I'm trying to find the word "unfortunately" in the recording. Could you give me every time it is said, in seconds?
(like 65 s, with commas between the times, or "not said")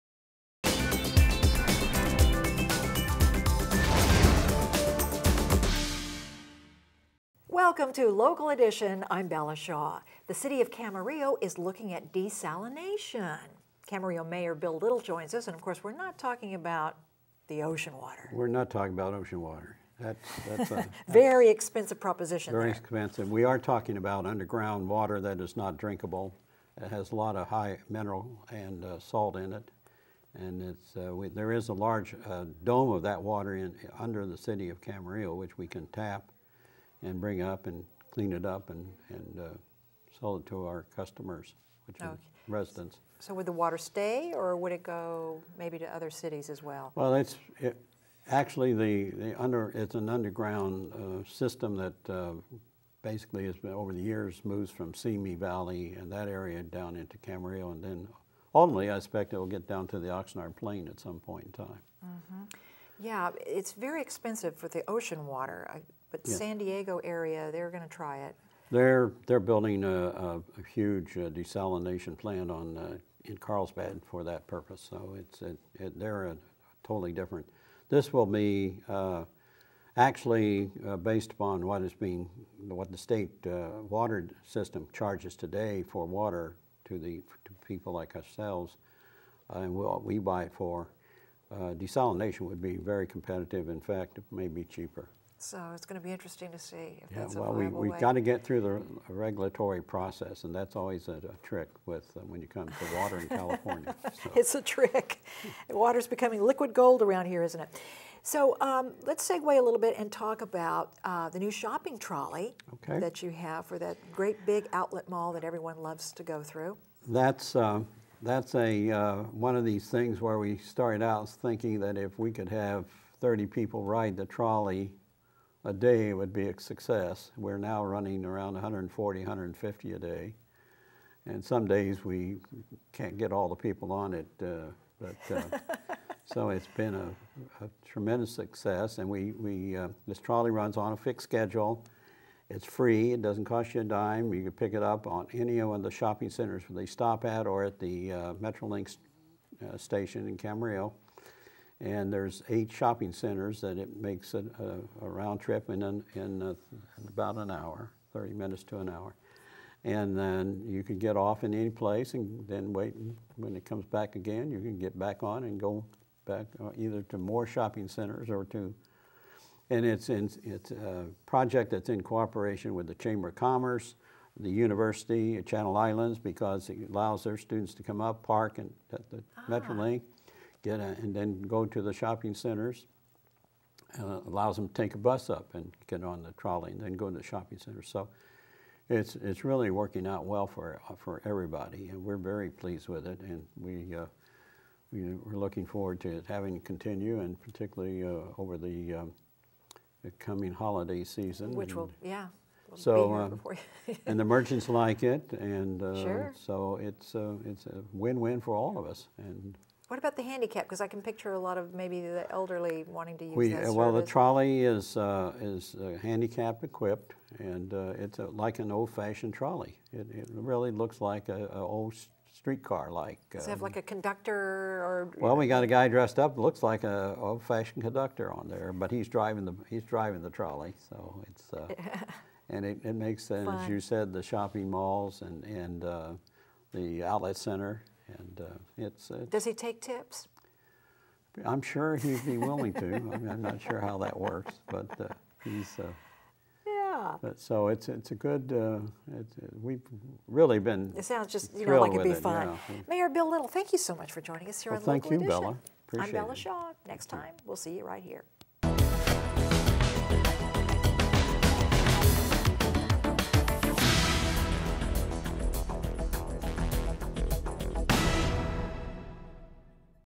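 not said.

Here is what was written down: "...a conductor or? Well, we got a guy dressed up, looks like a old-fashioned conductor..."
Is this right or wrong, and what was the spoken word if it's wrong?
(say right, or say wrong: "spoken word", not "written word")
right.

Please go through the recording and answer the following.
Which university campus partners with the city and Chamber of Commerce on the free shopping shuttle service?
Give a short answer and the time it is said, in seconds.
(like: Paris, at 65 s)
Channel Islands, at 175 s.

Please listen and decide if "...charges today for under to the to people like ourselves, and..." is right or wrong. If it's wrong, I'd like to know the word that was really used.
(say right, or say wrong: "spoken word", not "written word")
wrong: "water", not "under".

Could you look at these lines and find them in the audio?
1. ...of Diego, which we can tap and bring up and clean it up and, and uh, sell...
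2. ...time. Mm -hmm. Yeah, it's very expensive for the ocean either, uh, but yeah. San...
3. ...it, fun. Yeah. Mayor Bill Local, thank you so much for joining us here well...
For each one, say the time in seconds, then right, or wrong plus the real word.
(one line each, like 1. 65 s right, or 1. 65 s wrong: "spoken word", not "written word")
1. 34 s wrong: "Camarillo", not "Diego"
2. 61 s wrong: "water", not "either"
3. 252 s wrong: "Little", not "Local".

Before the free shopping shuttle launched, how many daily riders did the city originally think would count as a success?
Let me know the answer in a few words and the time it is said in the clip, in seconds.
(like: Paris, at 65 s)
30, at 123 s.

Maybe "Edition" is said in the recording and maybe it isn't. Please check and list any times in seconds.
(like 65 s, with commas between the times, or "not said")
8 s, 255 s.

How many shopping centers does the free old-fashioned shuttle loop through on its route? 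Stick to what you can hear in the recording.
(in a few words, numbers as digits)
8.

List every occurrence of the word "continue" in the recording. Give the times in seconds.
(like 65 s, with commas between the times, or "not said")
196 s.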